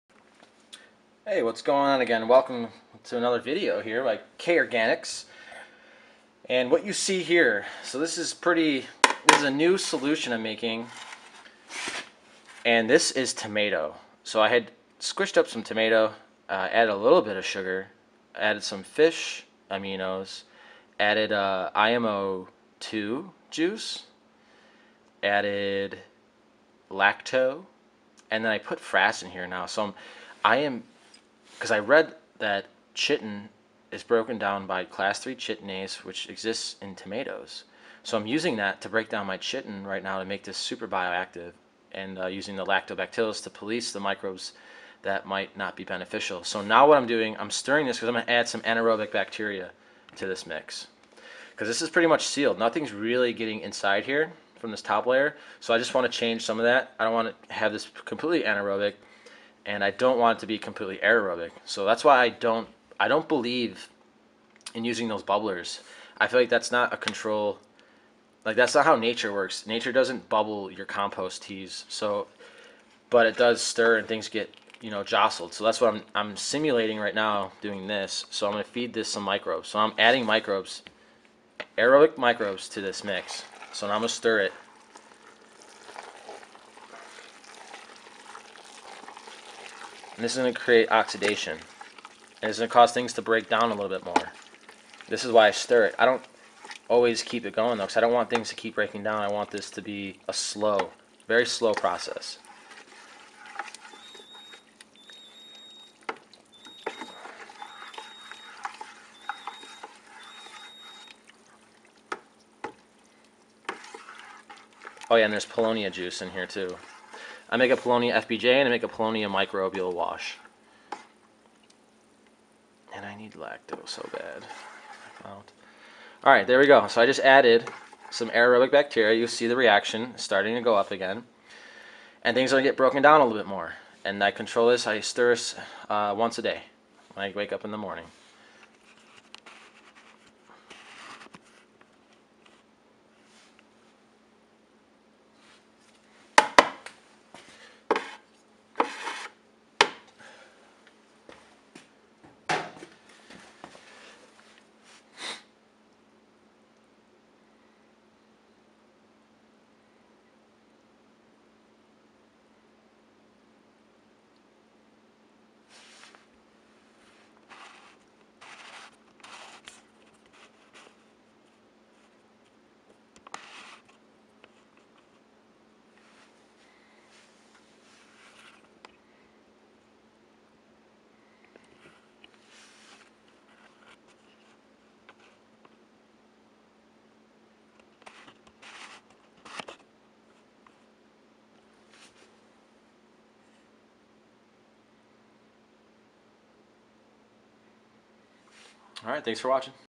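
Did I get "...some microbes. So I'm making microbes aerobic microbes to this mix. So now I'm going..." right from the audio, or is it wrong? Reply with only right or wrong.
wrong.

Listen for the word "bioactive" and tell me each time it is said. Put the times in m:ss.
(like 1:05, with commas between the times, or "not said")
0:40.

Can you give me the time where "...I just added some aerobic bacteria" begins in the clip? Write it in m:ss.
2:07.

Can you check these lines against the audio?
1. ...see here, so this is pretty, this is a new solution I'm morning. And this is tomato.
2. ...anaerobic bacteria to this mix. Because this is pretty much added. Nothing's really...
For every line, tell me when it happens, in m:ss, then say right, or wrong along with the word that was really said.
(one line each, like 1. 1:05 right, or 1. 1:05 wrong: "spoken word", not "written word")
1. 0:06 wrong: "making", not "morning"
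2. 0:48 wrong: "sealed", not "added".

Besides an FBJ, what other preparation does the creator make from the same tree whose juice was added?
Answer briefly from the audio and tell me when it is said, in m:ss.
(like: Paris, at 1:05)
Paulownia microbial wash, at 1:58.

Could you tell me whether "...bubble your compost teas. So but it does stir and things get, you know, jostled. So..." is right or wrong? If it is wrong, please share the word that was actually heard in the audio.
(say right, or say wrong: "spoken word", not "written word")
right.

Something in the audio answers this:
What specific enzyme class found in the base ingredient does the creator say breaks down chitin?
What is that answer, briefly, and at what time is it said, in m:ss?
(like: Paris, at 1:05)
class 3 chitinase, at 0:34.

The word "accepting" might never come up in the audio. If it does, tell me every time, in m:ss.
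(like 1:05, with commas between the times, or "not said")
not said.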